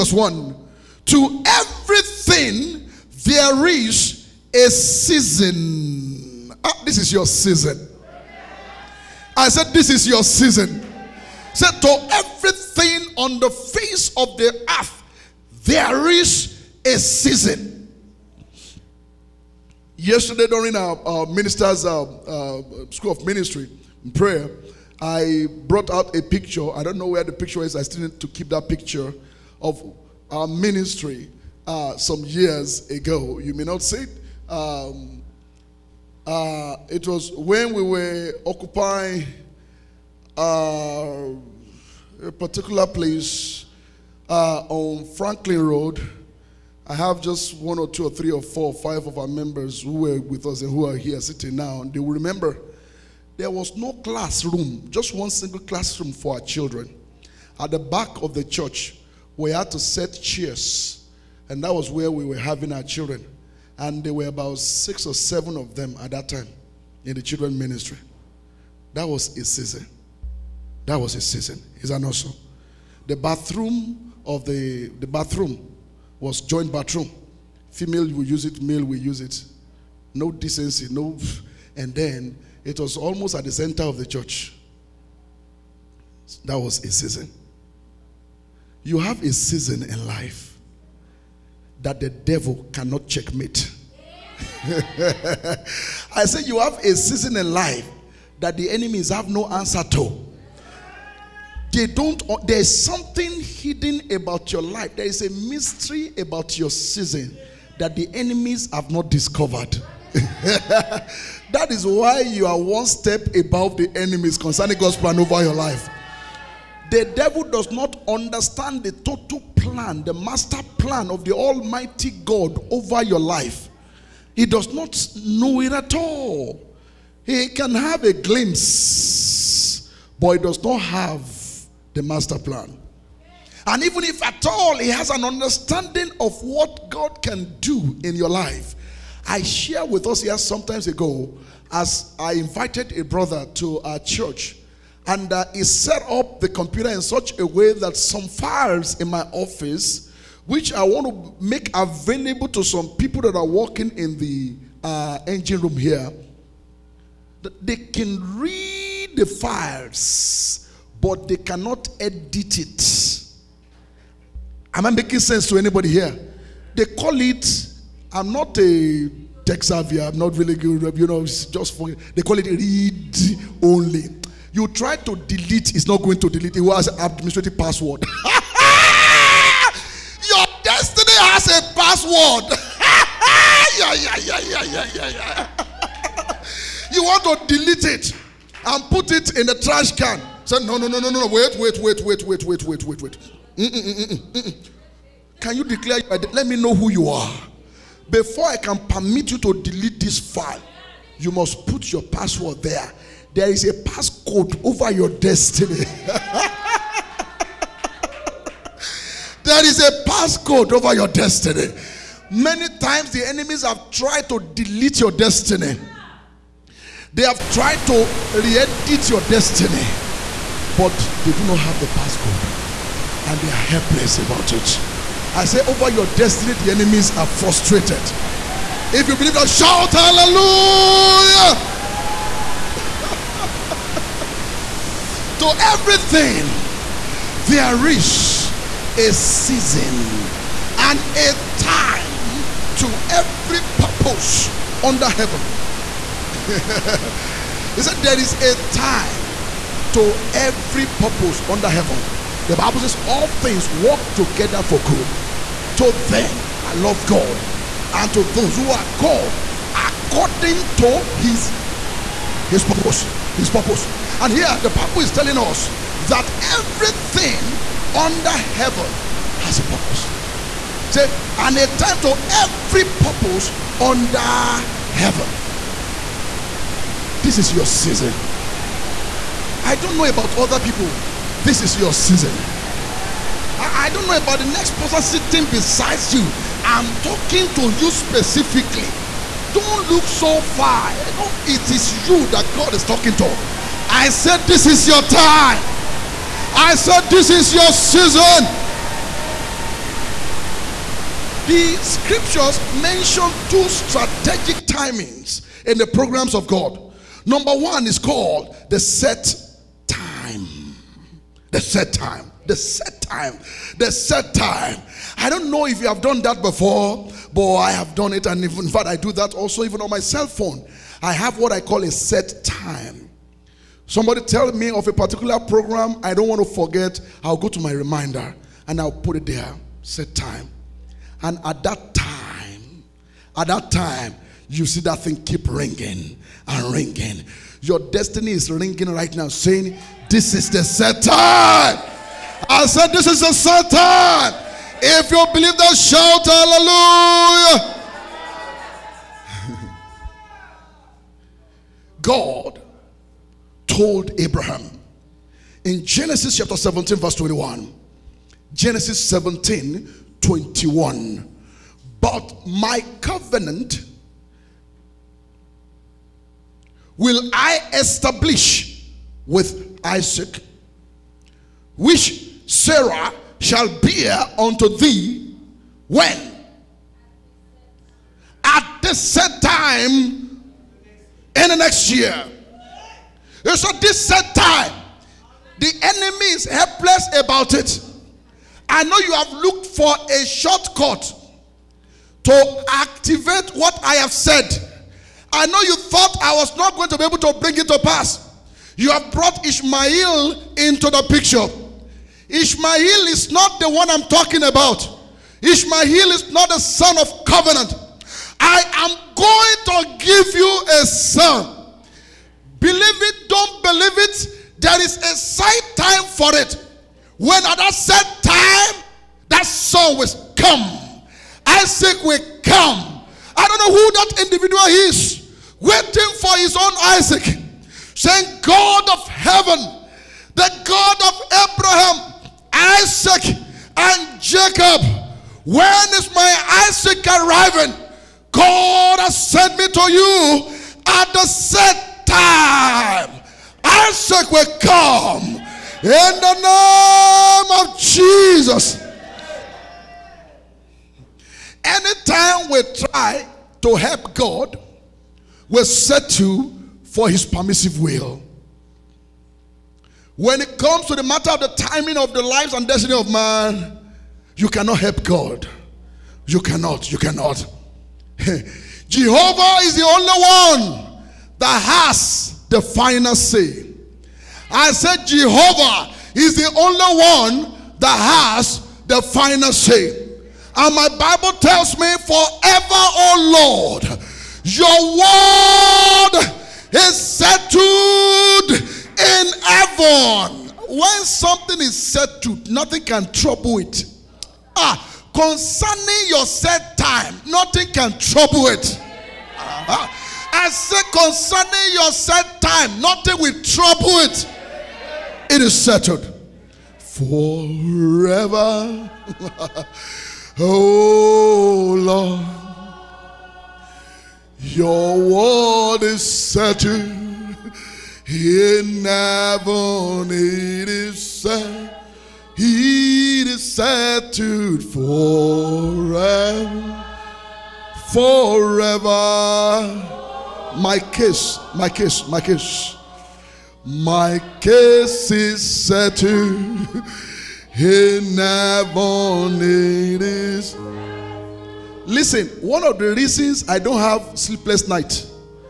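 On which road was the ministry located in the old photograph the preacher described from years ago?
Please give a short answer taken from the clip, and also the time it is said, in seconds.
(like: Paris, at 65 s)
Franklin Road, at 45 s.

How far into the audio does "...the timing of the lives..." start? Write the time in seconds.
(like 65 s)
461 s.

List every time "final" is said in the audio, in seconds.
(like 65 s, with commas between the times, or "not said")
472 s, 479 s.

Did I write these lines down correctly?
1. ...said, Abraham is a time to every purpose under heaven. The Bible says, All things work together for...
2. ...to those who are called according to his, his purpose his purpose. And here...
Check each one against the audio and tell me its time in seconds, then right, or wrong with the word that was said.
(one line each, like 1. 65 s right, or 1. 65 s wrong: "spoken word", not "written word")
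1. 246 s wrong: "There", not "Abraham"
2. 258 s right.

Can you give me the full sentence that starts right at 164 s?
Am I making sense to anybody here?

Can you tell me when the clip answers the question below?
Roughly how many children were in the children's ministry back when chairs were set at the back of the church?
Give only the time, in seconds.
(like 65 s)
64 s.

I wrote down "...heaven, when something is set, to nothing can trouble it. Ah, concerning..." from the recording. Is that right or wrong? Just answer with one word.
right.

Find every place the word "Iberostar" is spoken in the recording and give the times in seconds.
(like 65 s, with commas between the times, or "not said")
not said.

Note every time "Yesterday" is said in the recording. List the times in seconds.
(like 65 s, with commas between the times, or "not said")
19 s.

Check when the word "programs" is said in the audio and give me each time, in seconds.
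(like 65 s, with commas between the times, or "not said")
305 s, 325 s.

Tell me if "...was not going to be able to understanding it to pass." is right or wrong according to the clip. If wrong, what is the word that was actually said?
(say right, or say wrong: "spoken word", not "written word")
wrong: "bring", not "understanding".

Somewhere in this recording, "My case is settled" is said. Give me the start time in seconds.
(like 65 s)
533 s.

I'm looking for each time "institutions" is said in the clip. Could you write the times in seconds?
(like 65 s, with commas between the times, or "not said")
not said.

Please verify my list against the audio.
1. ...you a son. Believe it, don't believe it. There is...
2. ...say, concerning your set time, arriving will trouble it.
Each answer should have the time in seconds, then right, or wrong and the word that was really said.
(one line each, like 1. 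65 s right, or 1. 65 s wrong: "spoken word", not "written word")
1. 410 s right
2. 500 s wrong: "nothing", not "arriving".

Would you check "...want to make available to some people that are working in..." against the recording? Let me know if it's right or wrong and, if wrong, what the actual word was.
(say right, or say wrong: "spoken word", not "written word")
right.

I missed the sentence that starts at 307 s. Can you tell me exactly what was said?
Number one is called the set time.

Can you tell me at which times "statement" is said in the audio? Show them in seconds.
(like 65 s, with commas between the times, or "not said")
not said.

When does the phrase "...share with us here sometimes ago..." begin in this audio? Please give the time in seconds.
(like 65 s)
139 s.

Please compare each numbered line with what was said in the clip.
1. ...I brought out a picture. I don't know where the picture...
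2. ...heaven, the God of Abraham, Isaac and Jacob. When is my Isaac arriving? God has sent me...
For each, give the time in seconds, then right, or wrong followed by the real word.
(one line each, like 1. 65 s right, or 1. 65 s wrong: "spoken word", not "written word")
1. 25 s right
2. 429 s right.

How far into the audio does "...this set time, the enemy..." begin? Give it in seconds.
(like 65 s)
383 s.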